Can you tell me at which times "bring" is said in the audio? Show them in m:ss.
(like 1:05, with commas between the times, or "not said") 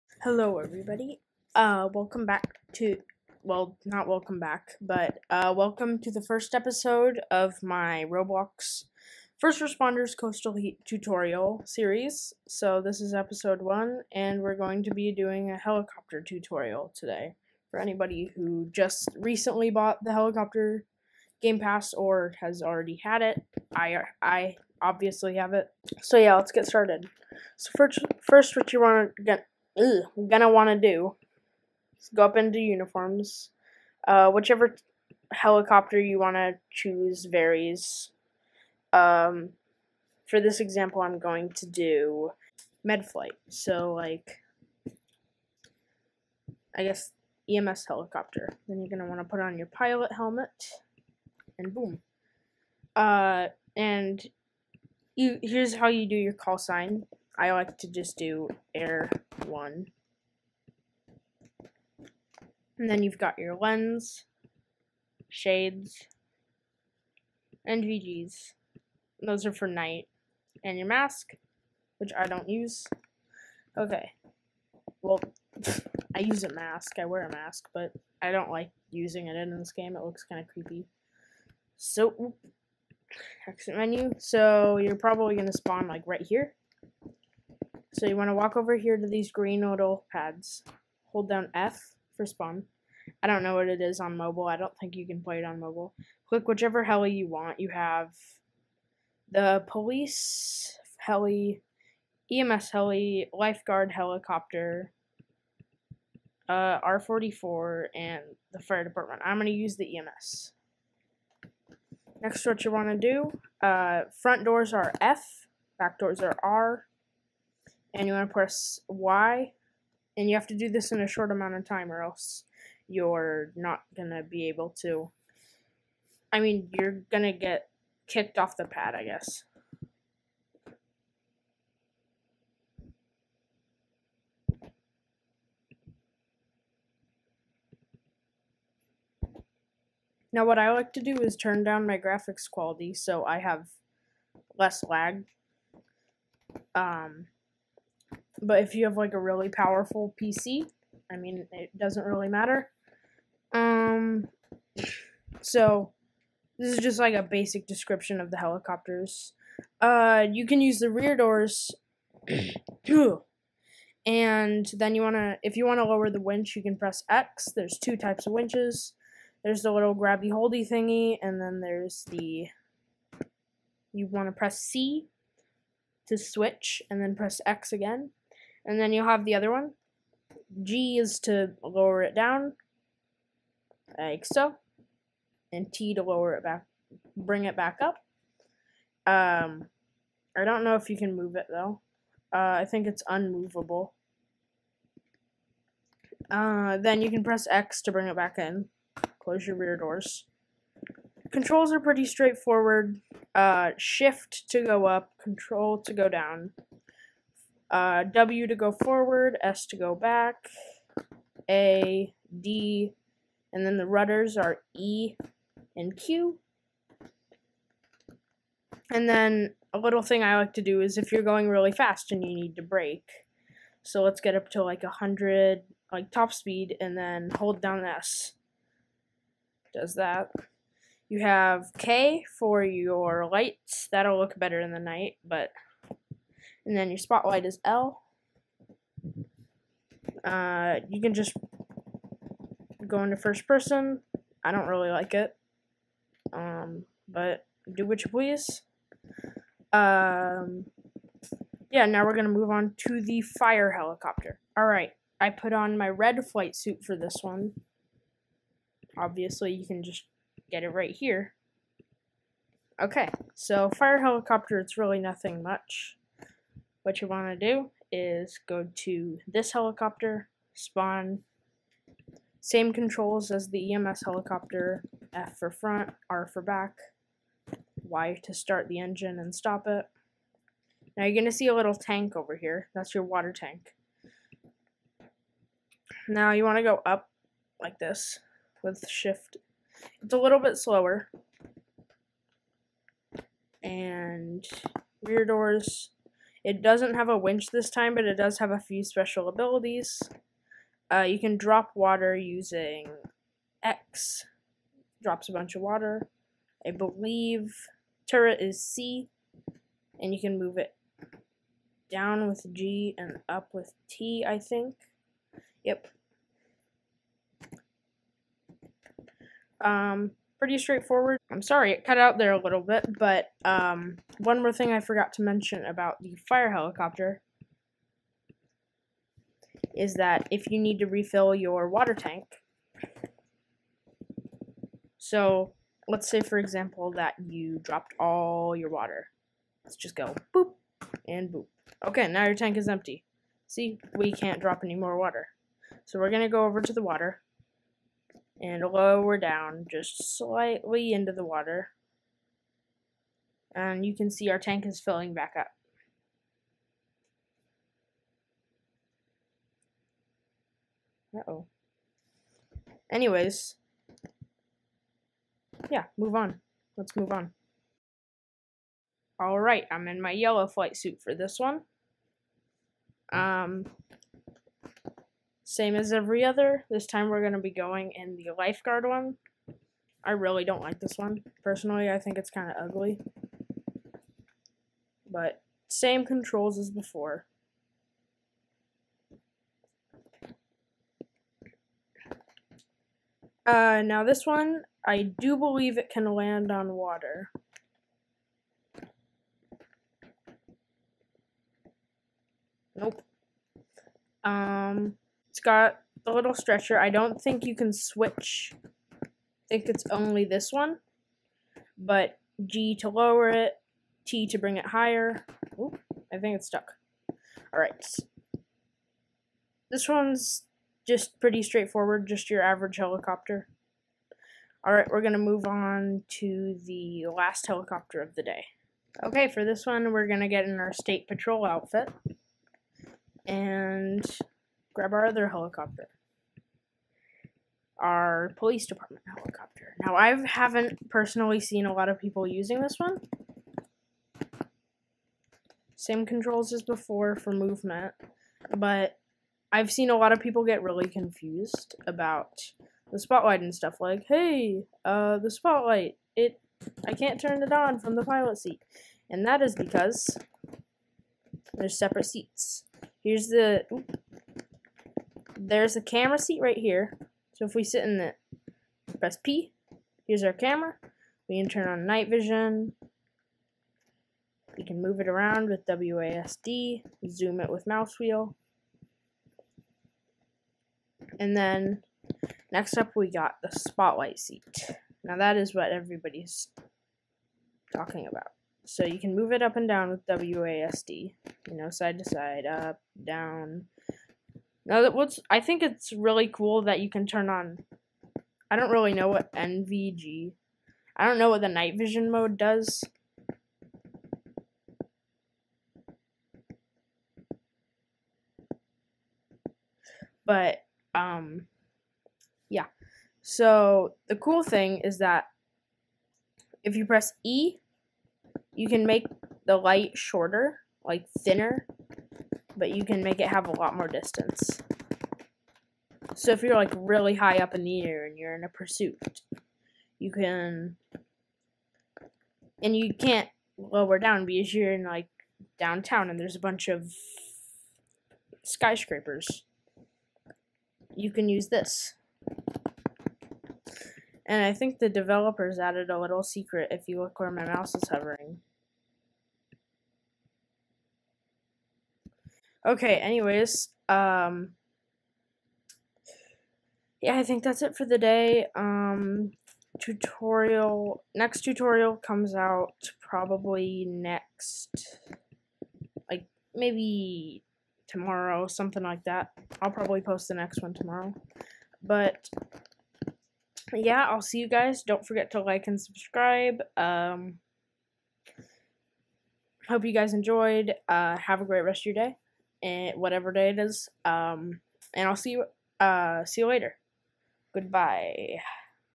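3:07, 3:17, 6:54.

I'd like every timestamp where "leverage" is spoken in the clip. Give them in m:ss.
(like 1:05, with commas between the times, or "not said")
not said.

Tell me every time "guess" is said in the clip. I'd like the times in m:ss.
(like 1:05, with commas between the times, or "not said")
0:46, 2:09.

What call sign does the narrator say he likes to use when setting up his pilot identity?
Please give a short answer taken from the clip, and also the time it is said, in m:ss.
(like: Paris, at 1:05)
Air one, at 0:58.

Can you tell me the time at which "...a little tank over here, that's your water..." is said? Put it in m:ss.
4:41.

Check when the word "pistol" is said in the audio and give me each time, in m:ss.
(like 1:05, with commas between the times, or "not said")
not said.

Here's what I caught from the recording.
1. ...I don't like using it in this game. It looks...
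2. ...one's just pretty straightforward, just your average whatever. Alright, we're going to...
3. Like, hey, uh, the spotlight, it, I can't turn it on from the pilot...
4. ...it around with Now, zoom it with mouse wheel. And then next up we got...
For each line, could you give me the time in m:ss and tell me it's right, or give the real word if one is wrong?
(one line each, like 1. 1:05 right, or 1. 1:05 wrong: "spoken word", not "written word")
1. 1:18 right
2. 6:59 wrong: "helicopter", not "whatever"
3. 7:33 right
4. 7:54 wrong: "WASD", not "Now".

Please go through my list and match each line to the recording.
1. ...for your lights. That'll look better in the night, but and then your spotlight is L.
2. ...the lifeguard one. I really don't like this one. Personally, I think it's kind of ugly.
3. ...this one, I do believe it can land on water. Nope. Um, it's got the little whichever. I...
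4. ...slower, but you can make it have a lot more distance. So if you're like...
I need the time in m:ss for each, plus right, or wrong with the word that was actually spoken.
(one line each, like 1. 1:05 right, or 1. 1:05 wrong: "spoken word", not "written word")
1. 3:52 right
2. 6:18 right
3. 6:34 wrong: "stretcher", not "whichever"
4. 8:41 wrong: "thinner", not "slower".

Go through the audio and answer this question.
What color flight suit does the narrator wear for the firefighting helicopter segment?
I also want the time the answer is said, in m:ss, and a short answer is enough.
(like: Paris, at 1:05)
Red, at 4:15.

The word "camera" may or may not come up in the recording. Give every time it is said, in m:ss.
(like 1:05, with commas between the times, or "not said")
7:45, 7:50.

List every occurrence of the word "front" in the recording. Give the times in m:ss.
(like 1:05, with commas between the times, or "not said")
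1:54, 4:35.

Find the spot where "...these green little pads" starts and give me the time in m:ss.
1:29.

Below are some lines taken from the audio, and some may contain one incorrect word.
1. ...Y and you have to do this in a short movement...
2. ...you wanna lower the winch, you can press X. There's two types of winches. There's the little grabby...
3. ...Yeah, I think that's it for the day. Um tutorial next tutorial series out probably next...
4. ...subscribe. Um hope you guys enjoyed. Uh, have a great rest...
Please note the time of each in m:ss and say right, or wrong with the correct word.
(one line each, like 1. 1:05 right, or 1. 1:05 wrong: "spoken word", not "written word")
1. 1:58 wrong: "amount", not "movement"
2. 2:45 right
3. 9:17 wrong: "comes", not "series"
4. 9:35 right.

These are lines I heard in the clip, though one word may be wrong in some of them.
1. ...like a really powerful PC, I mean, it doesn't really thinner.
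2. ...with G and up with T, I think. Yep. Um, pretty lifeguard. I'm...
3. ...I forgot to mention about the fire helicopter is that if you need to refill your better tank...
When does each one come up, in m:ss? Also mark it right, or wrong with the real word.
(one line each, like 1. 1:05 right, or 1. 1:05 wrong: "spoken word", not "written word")
1. 2:28 wrong: "matter", not "thinner"
2. 5:12 wrong: "straightforward", not "lifeguard"
3. 5:24 wrong: "water", not "better".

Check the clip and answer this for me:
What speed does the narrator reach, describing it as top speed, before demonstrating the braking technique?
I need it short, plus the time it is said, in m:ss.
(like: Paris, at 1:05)
100, at 3:44.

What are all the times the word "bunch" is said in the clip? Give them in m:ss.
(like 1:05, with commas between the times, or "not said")
5:05, 8:56.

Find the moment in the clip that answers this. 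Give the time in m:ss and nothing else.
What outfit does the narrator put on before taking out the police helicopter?
7:10.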